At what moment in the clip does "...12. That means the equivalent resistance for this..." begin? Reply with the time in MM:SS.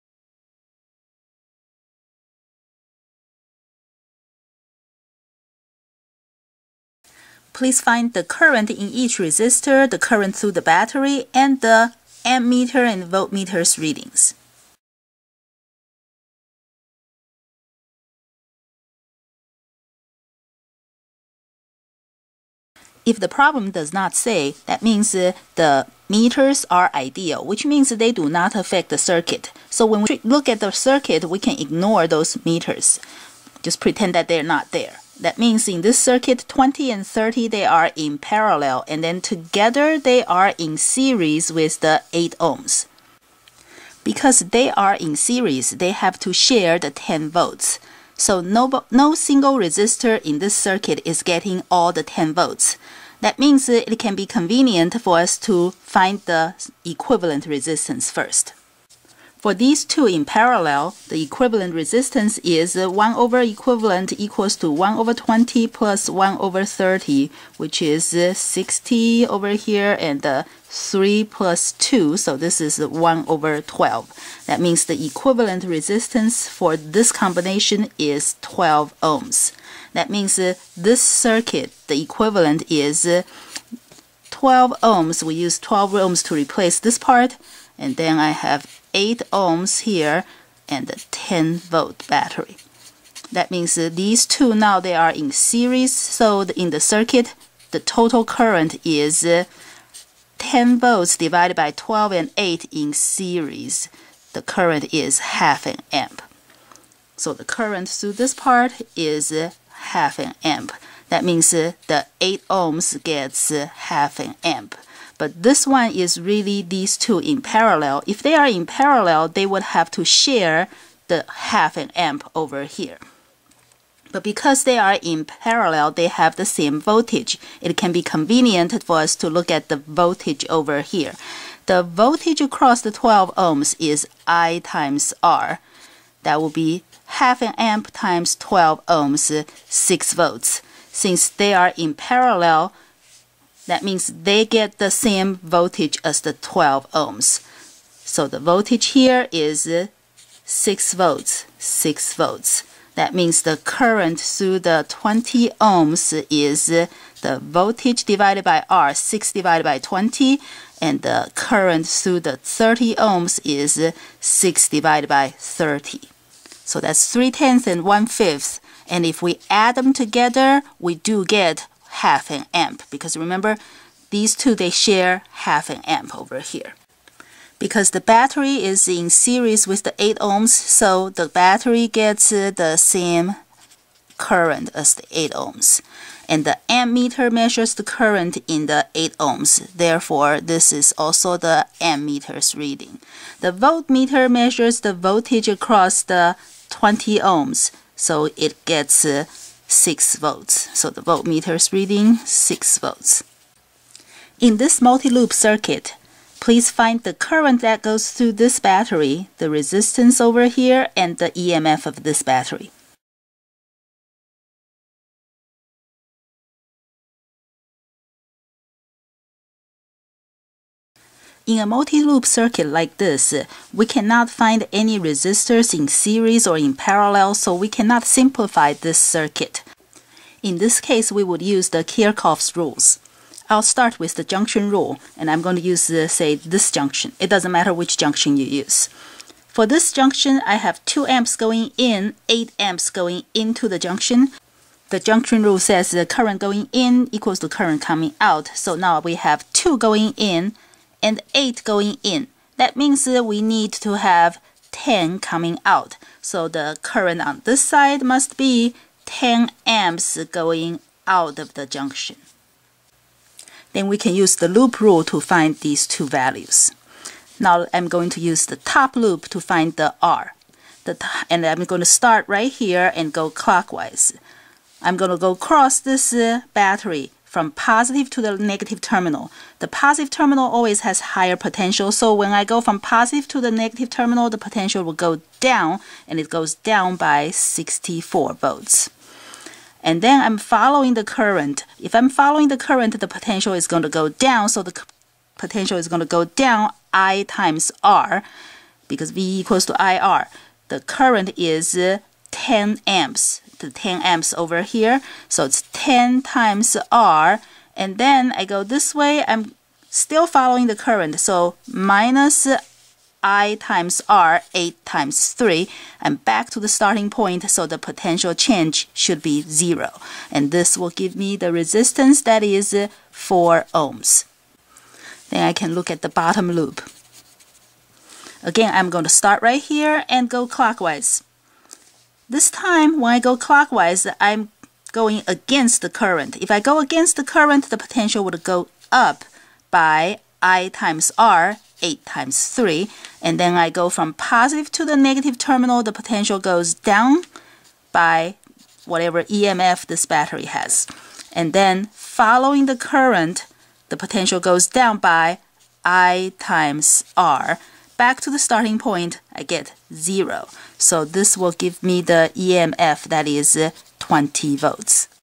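01:13.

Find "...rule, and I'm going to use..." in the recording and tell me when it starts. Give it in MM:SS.
03:54.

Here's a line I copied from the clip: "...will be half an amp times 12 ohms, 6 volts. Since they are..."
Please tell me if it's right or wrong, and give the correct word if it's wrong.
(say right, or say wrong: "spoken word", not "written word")
right.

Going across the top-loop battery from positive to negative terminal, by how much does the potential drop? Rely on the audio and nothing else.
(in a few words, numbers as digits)
64 volts.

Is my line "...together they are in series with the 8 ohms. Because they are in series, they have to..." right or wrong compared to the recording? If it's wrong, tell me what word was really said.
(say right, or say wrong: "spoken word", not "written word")
right.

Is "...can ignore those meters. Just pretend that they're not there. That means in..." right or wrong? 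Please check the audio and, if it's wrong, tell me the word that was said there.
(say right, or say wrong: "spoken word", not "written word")
right.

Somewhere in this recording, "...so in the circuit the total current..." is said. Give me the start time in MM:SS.
01:35.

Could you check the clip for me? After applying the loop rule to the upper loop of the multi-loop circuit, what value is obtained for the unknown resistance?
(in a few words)
4 ohms.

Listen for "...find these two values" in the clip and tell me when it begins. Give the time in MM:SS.
04:25.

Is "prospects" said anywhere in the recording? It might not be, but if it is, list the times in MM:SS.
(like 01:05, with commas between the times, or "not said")
not said.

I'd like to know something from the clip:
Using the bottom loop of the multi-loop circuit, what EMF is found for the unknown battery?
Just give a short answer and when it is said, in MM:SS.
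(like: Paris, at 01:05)
20 volts, at 06:03.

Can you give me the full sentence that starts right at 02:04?
But because they are in parallel, they have the same voltage.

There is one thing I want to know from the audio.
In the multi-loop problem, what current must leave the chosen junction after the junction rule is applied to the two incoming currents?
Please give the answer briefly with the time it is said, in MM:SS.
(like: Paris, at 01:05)
10 amps, at 04:19.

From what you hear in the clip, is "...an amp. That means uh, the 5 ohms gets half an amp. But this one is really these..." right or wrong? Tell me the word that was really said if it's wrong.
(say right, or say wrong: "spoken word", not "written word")
wrong: "8", not "5".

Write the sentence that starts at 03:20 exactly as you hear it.
So the voltmeter is reading 6 volts.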